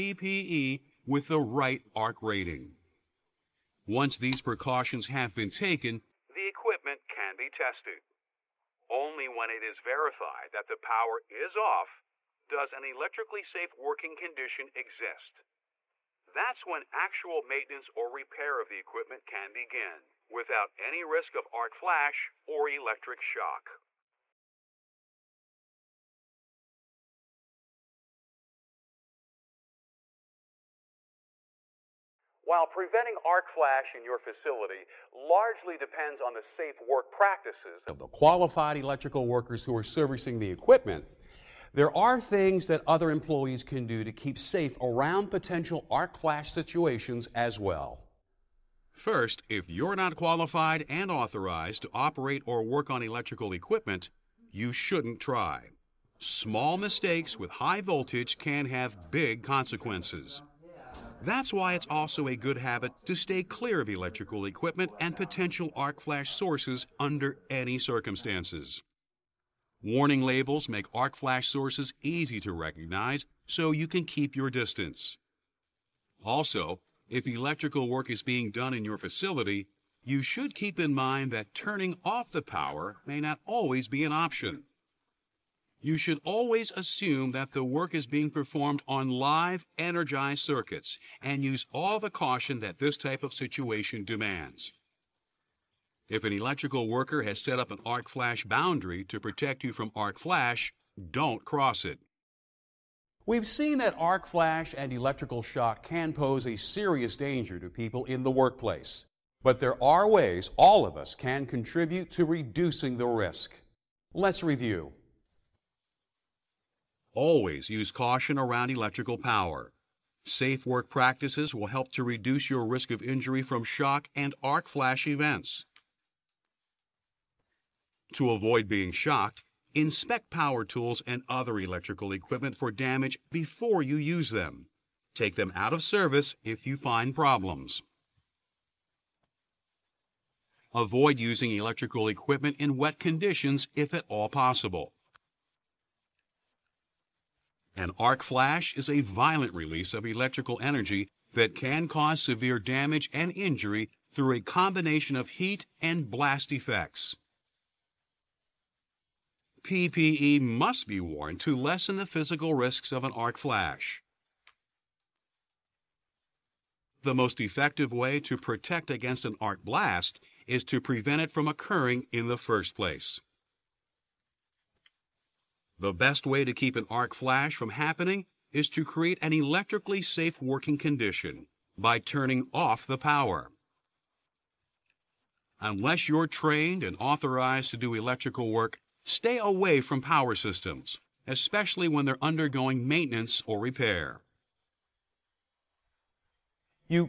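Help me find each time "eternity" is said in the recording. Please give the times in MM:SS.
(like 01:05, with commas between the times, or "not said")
not said.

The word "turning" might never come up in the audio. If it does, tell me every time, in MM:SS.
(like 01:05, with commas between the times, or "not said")
01:21, 03:01.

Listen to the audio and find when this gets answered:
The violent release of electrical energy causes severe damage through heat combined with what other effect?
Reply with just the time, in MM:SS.
02:36.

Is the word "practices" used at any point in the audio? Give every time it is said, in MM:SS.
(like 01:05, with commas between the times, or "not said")
00:37, 02:00.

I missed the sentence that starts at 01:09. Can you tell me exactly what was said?
Warning labels make arc flash sources easy to recognize so you can keep your distance.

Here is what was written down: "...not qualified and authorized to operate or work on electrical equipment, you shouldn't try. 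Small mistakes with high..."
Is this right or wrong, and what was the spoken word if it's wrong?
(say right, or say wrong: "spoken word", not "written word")
right.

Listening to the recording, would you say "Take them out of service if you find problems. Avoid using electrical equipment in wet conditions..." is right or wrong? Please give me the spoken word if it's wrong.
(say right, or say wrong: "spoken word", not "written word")
right.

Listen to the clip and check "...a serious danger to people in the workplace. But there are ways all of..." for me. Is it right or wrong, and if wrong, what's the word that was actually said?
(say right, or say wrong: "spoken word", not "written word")
right.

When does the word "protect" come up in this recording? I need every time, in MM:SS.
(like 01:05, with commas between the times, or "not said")
01:39, 02:48.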